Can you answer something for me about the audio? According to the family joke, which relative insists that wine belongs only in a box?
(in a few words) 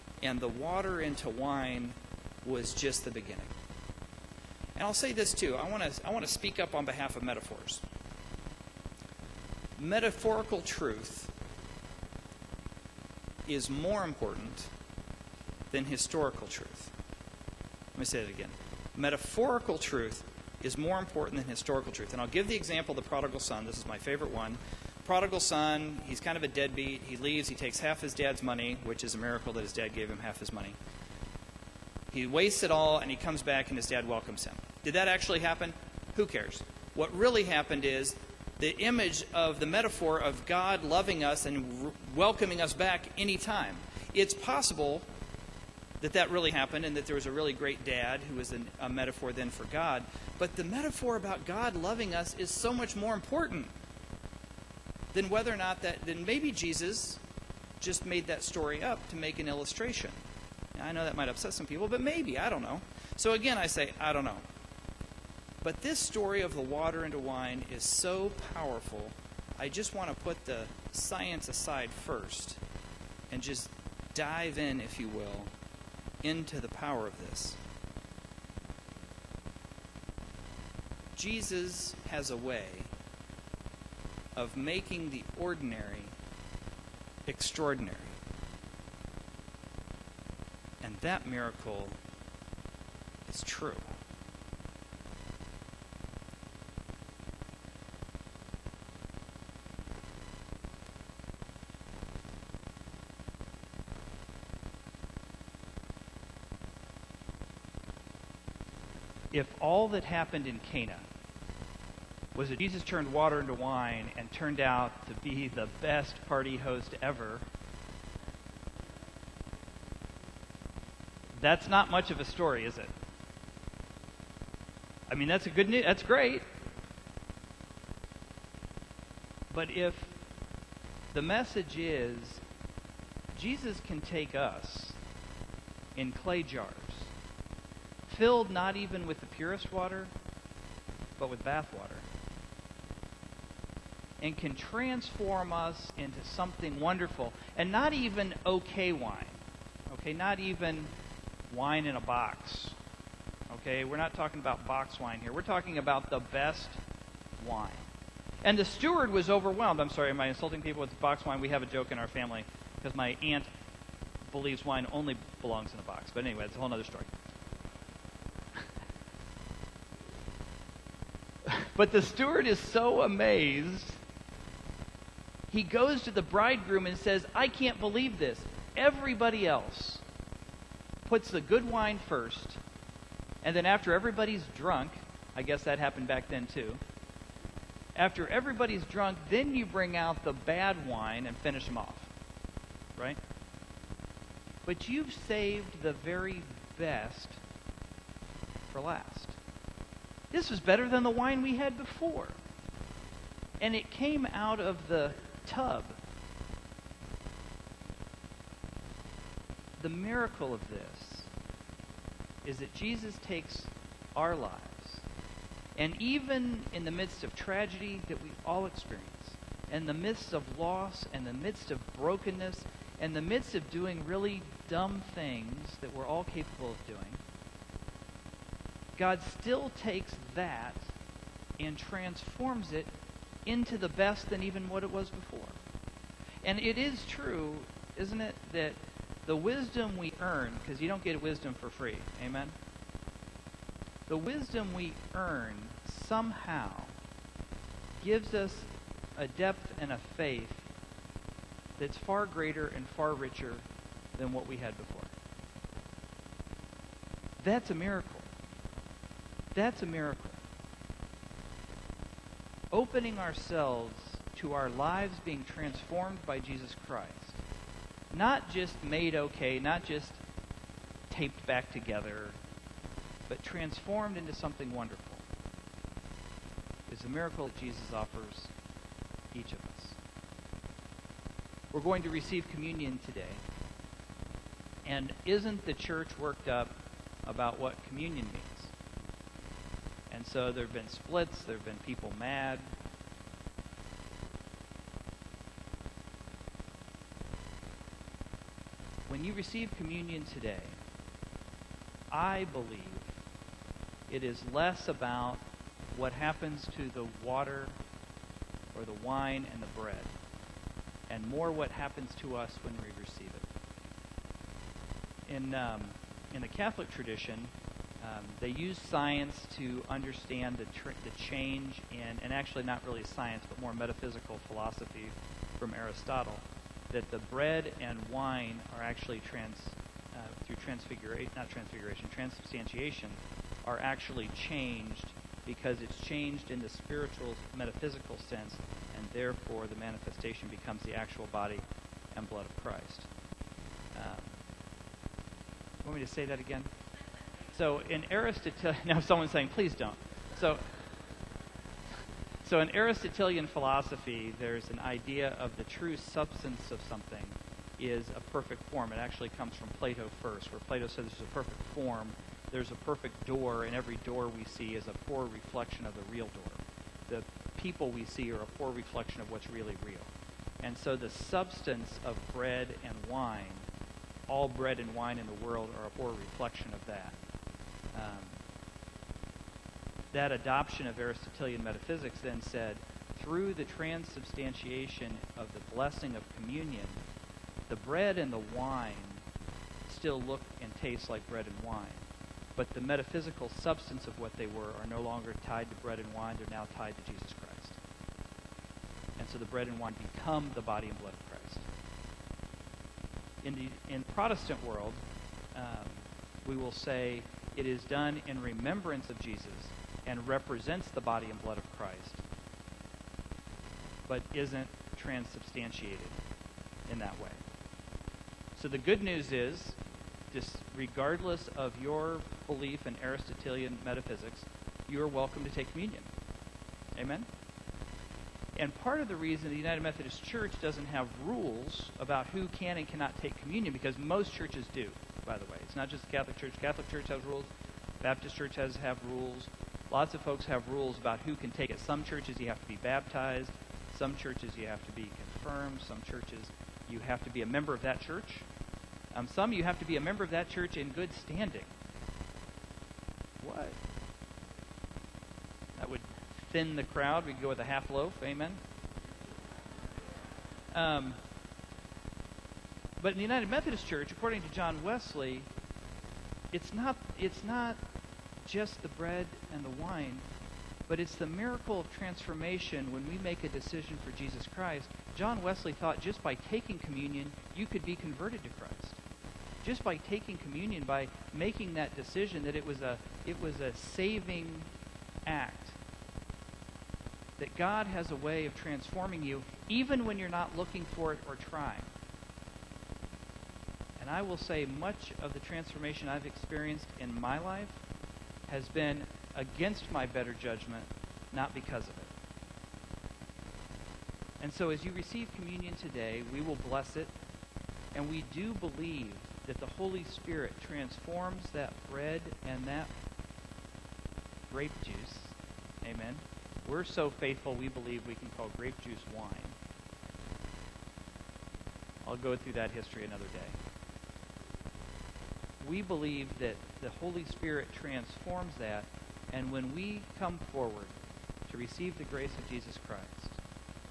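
aunt.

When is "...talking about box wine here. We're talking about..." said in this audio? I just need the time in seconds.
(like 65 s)
154 s.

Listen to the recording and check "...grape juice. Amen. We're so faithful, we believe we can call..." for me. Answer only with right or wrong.
right.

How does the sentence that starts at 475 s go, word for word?
John Wesley thought just by taking communion, you could be converted to Christ.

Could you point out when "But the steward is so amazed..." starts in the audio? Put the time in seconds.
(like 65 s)
171 s.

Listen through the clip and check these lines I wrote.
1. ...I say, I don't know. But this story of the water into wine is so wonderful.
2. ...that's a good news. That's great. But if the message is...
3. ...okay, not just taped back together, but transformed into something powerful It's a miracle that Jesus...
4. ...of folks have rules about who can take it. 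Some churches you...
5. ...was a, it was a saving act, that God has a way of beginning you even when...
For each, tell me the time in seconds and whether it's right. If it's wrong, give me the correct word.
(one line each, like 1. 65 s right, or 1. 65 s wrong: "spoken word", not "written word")
1. 63 s wrong: "powerful", not "wonderful"
2. 125 s right
3. 269 s wrong: "wonderful", not "powerful"
4. 440 s right
5. 482 s wrong: "transforming", not "beginning".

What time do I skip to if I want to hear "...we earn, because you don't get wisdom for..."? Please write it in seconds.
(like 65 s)
239 s.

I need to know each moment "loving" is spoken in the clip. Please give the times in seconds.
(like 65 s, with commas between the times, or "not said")
40 s, 51 s.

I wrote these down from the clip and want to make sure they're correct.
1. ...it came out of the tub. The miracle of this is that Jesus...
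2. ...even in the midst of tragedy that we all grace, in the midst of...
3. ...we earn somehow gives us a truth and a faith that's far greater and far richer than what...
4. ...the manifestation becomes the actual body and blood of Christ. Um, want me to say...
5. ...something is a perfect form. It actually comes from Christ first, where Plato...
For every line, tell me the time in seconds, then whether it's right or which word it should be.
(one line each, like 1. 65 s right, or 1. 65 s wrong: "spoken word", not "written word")
1. 203 s right
2. 216 s wrong: "experience", not "grace"
3. 244 s wrong: "depth", not "truth"
4. 339 s right
5. 356 s wrong: "Plato", not "Christ".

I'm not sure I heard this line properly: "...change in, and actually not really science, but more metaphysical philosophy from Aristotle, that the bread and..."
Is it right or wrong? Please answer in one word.
right.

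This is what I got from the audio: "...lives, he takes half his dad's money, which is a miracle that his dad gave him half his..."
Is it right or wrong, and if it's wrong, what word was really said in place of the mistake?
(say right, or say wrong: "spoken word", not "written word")
wrong: "leaves", not "lives".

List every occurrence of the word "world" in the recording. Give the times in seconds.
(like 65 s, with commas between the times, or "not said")
375 s, 404 s.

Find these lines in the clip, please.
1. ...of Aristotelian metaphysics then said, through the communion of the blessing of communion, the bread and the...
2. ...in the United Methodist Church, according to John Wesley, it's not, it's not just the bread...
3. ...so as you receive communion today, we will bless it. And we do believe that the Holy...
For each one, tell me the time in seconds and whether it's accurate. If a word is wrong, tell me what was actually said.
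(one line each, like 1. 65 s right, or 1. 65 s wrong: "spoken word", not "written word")
1. 380 s wrong: "transubstantiation", not "communion"
2. 463 s right
3. 504 s right.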